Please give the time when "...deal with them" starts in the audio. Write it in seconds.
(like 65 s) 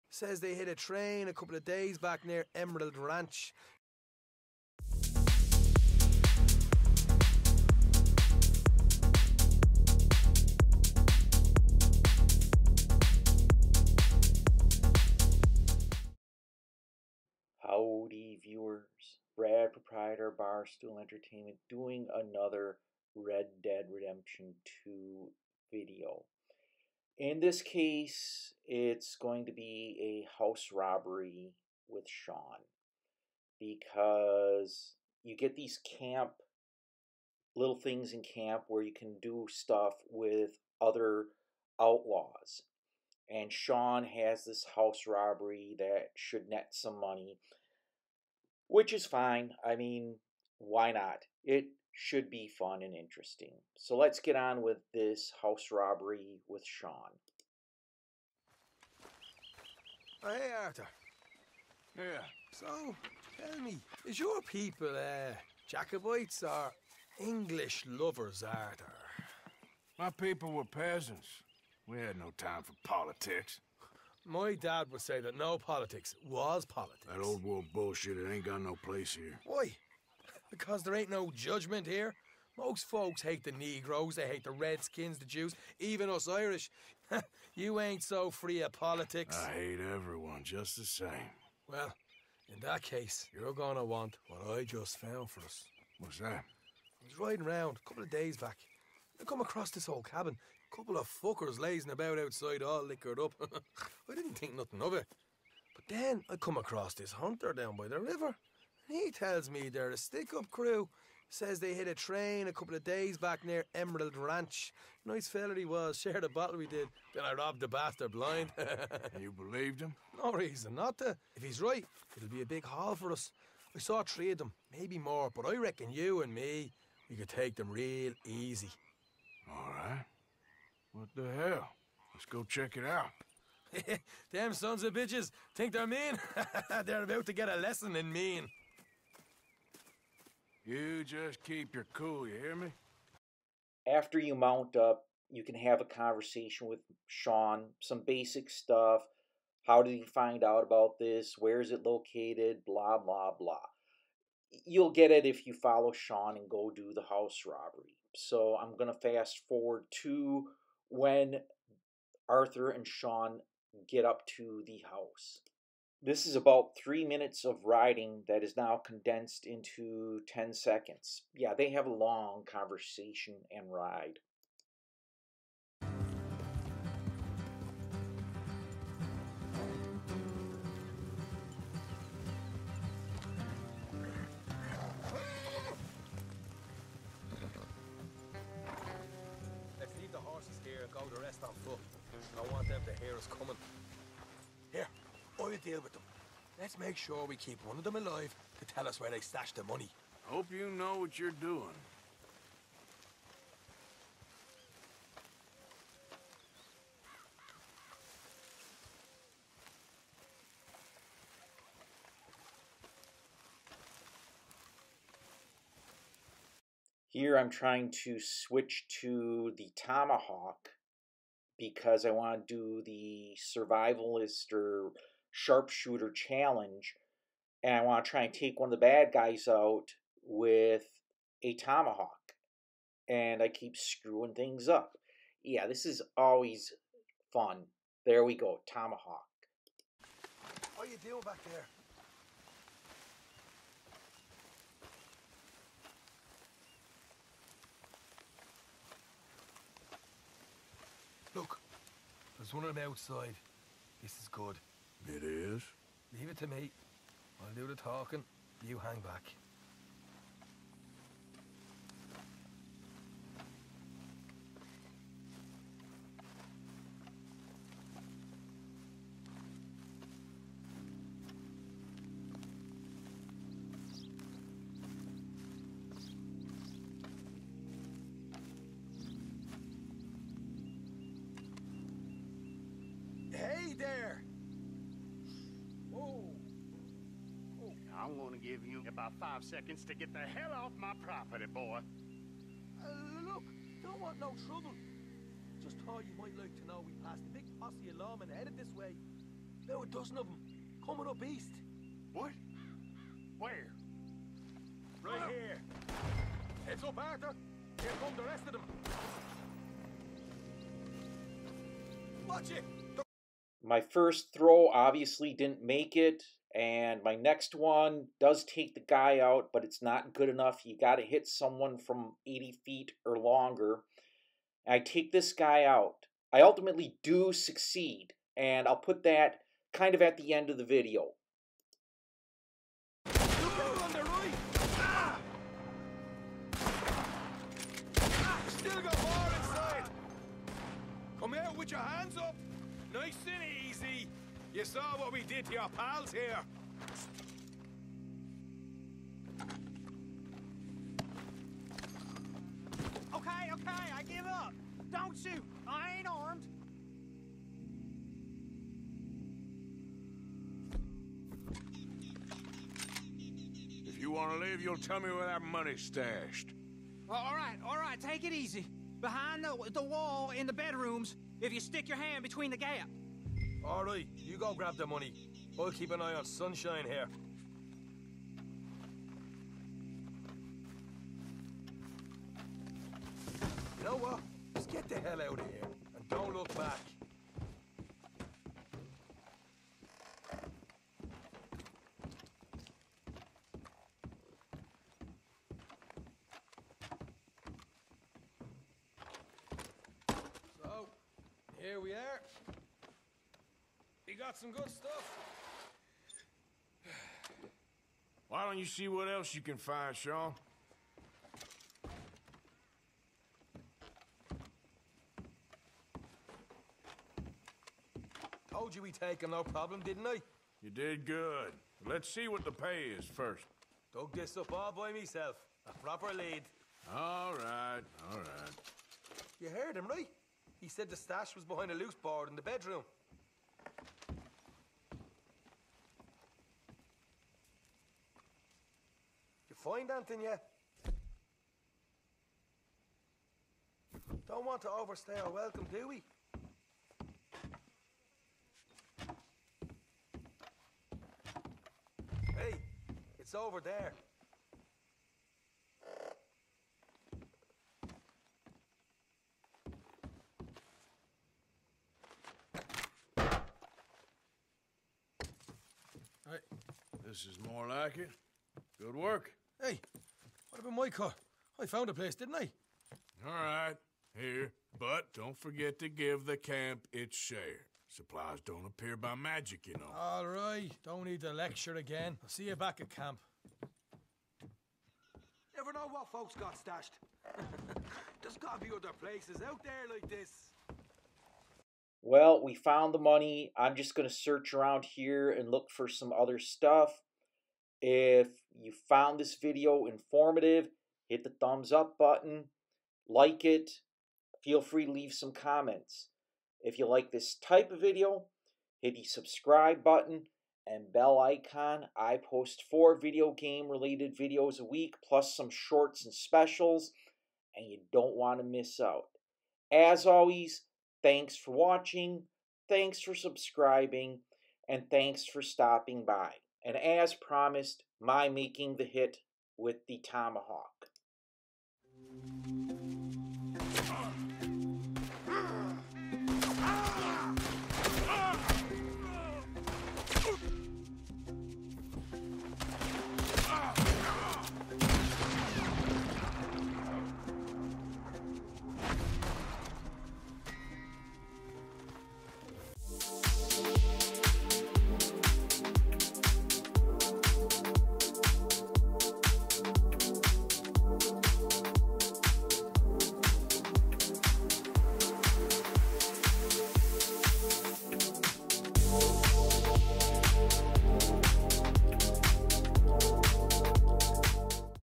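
195 s.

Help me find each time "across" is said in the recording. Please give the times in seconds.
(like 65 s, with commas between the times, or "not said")
99 s, 106 s.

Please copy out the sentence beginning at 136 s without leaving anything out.
they're about to get a lesson in mean.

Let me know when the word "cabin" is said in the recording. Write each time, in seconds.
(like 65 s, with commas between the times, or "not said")
100 s.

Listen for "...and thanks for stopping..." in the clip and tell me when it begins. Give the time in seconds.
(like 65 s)
524 s.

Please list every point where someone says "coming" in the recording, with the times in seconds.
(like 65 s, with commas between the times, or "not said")
193 s, 300 s.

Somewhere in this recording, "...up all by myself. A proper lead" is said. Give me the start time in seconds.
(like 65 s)
424 s.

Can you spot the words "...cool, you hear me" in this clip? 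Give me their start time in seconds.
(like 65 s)
141 s.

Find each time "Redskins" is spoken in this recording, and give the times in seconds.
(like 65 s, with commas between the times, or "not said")
84 s.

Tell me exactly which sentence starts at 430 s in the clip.
He said the stash was behind a loose board in the bedroom.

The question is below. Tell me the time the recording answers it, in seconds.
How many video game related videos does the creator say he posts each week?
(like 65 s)
512 s.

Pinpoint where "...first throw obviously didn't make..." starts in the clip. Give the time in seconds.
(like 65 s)
313 s.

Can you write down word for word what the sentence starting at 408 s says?
Why don't you see what else you can find, Sean?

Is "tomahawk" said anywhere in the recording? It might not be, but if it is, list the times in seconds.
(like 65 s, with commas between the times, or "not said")
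219 s, 231 s, 238 s, 529 s.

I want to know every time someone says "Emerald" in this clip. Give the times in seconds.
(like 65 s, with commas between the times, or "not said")
2 s, 113 s.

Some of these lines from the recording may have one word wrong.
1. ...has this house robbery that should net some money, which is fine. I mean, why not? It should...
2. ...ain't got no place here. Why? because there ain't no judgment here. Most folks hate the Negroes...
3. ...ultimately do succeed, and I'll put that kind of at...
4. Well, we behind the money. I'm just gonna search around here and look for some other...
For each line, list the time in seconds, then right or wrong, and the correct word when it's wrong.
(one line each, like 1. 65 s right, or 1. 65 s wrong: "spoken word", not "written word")
1. 44 s right
2. 78 s right
3. 326 s right
4. 492 s wrong: "found", not "behind".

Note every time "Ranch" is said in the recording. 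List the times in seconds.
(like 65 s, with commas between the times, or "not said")
2 s, 114 s.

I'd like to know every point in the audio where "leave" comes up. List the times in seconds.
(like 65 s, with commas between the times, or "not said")
190 s, 256 s, 364 s, 504 s.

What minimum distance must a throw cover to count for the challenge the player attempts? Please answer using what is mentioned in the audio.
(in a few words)
80 feet.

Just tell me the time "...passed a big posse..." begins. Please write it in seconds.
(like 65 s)
297 s.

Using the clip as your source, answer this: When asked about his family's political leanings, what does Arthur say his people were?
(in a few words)
peasants.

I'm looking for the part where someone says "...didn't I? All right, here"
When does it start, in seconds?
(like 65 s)
472 s.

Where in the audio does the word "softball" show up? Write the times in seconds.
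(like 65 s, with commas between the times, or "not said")
not said.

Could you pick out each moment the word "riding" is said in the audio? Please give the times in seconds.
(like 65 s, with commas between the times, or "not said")
97 s, 167 s.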